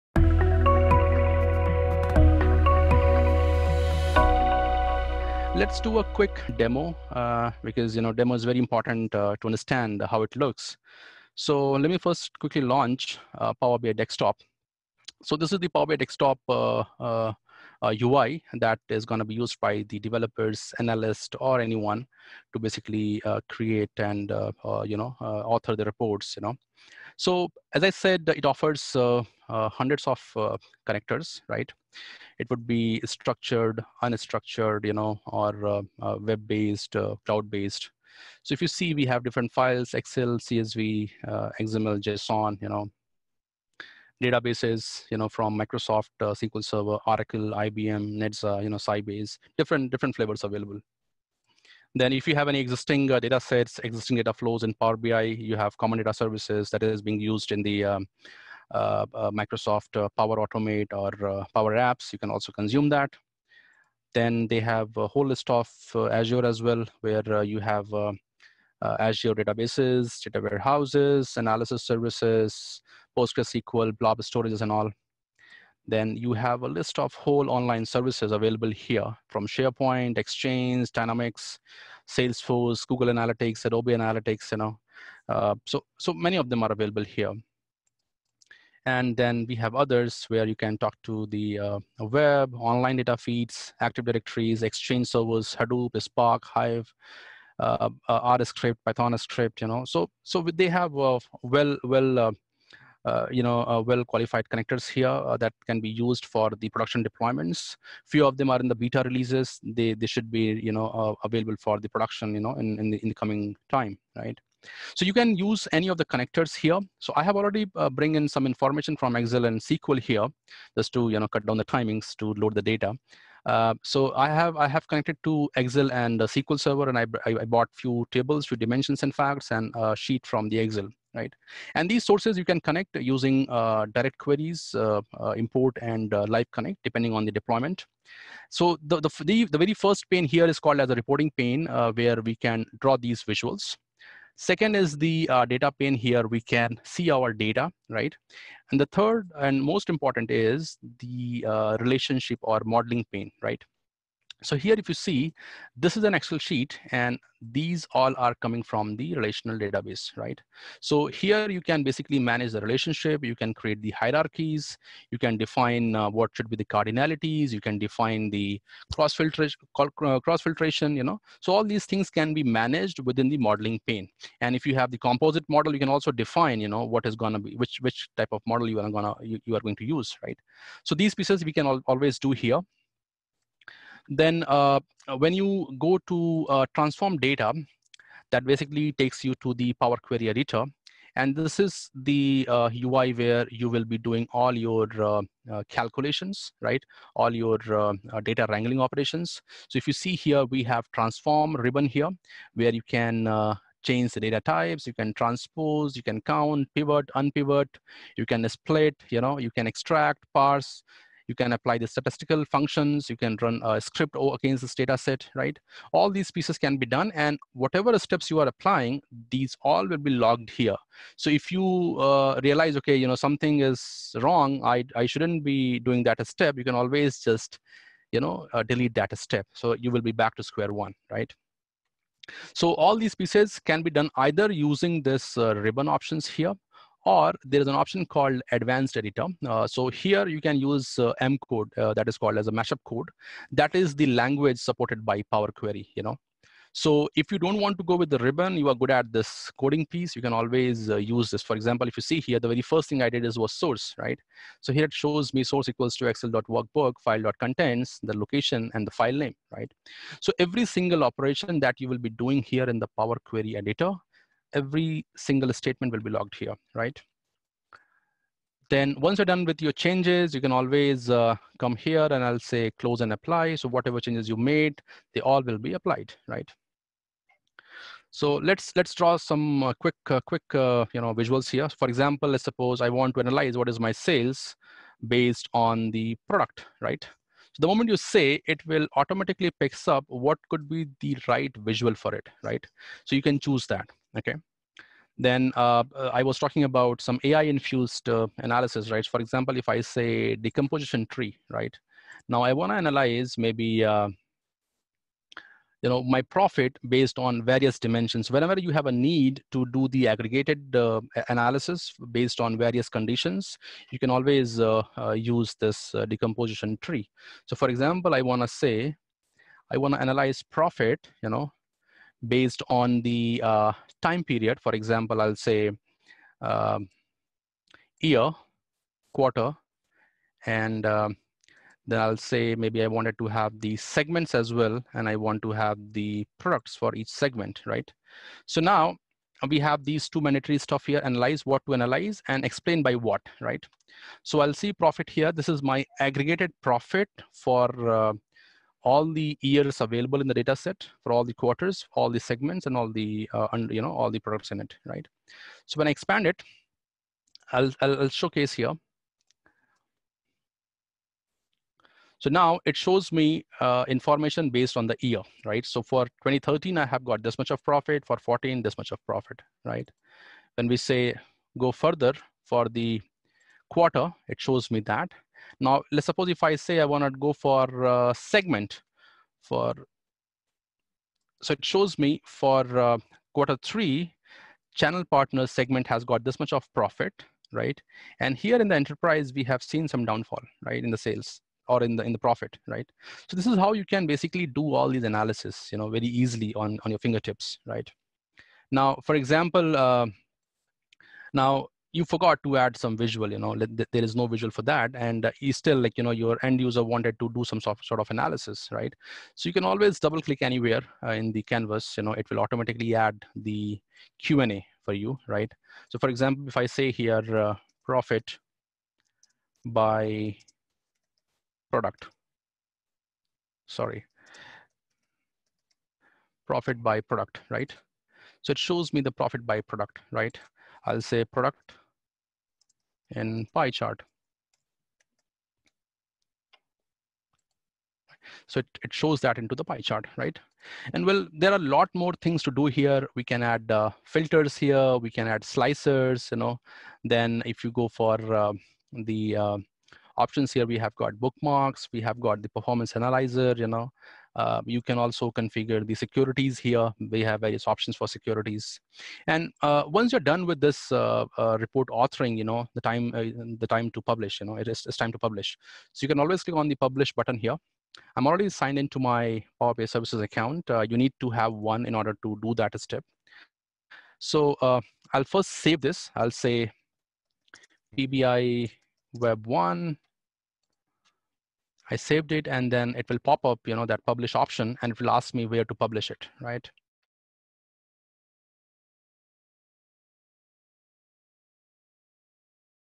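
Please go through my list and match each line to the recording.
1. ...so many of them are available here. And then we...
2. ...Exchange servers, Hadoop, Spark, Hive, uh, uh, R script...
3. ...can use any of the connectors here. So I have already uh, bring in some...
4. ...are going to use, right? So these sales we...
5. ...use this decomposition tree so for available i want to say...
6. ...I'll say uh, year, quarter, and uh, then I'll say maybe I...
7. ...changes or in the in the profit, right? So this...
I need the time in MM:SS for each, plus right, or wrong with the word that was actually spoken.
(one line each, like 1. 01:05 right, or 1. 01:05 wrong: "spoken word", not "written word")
1. 01:25 right
2. 01:34 right
3. 01:55 right
4. 02:59 wrong: "pieces", not "sales"
5. 05:15 wrong: "example", not "available"
6. 05:25 right
7. 06:30 wrong: "sales", not "changes".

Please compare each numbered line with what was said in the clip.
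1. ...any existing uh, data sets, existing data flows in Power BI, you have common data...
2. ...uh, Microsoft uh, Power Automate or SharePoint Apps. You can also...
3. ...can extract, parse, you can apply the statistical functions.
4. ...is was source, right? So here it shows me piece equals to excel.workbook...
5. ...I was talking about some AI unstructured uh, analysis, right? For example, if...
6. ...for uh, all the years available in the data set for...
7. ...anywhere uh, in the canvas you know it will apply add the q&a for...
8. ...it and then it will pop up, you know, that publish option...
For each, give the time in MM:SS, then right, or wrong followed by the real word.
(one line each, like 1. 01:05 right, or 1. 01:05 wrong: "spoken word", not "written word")
1. 00:52 right
2. 00:59 wrong: "Power", not "SharePoint"
3. 03:29 right
4. 04:13 wrong: "source", not "piece"
5. 04:56 wrong: "infused", not "unstructured"
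6. 05:47 right
7. 06:50 wrong: "automatically", not "apply"
8. 08:02 right.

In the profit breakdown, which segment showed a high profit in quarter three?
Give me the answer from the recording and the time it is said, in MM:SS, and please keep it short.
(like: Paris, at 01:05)
Channel partner, at 06:24.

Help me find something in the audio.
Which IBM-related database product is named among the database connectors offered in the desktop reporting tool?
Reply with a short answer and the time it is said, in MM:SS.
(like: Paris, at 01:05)
Netezza, at 00:48.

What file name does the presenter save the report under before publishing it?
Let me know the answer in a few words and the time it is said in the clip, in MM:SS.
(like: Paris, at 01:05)
PBI Web 1, at 07:57.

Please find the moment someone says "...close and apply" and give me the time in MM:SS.
04:32.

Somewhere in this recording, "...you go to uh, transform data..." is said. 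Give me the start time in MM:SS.
03:05.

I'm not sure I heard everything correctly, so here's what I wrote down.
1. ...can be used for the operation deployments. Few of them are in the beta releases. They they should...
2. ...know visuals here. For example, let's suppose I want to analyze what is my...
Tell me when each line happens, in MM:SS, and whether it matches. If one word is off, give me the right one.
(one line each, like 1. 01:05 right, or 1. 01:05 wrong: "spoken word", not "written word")
1. 01:45 wrong: "production", not "operation"
2. 04:41 right.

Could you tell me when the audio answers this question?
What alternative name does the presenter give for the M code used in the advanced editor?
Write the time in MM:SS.
04:02.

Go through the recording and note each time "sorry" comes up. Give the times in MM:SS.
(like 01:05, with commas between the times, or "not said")
07:03.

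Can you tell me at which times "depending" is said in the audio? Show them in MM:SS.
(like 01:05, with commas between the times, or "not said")
02:16.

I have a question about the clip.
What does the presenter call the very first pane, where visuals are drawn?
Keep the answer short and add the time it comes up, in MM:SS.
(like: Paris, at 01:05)
Reporting pane, at 02:20.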